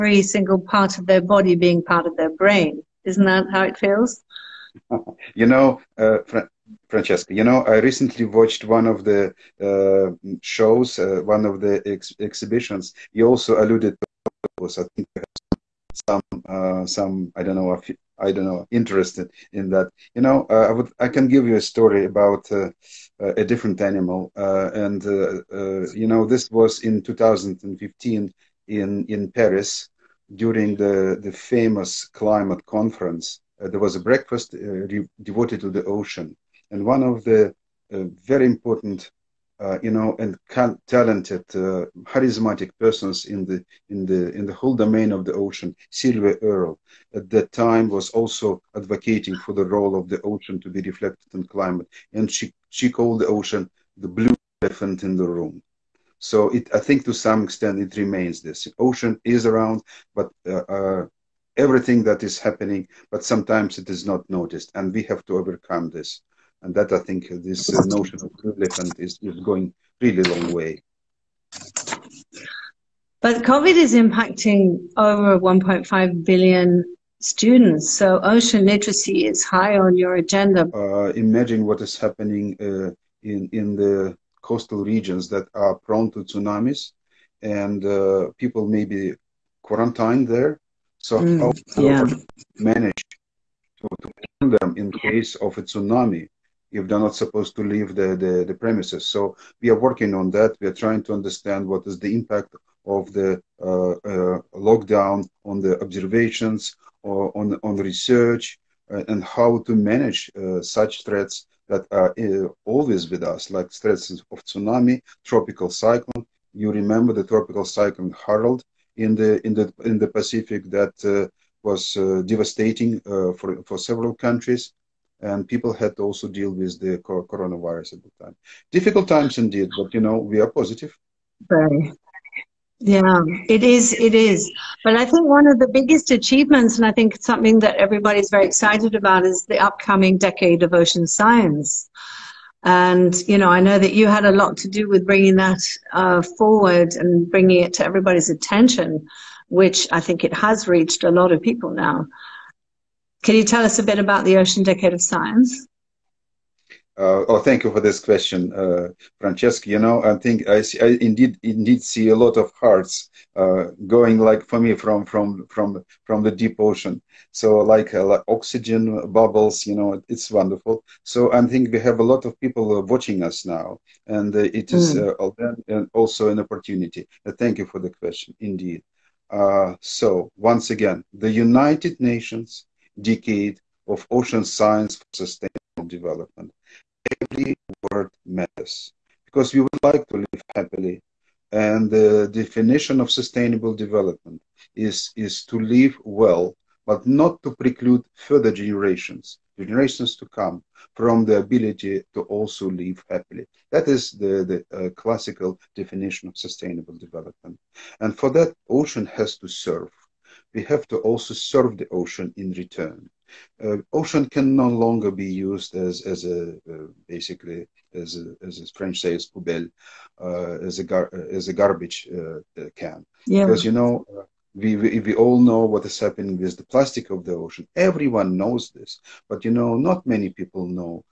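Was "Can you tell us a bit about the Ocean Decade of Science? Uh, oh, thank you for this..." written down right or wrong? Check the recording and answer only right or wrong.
right.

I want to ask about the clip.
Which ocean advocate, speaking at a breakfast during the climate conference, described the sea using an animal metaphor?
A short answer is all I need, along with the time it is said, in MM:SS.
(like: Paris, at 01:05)
Sylvia Earle, at 00:45.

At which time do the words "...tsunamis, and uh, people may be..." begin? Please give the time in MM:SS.
01:26.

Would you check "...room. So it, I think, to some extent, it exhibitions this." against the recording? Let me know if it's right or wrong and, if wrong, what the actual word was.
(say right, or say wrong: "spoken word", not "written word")
wrong: "remains", not "exhibitions".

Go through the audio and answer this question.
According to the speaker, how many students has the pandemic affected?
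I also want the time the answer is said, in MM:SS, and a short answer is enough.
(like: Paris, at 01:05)
1.5 billion, at 01:15.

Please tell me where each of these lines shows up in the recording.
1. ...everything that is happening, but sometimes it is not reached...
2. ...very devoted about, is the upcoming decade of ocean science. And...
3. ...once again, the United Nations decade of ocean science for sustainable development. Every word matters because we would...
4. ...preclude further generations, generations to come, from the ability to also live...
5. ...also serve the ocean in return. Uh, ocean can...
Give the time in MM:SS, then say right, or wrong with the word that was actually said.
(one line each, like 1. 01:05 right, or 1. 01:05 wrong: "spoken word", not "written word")
1. 01:01 wrong: "noticed", not "reached"
2. 02:18 wrong: "excited", not "devoted"
3. 03:00 right
4. 03:17 right
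5. 03:30 right.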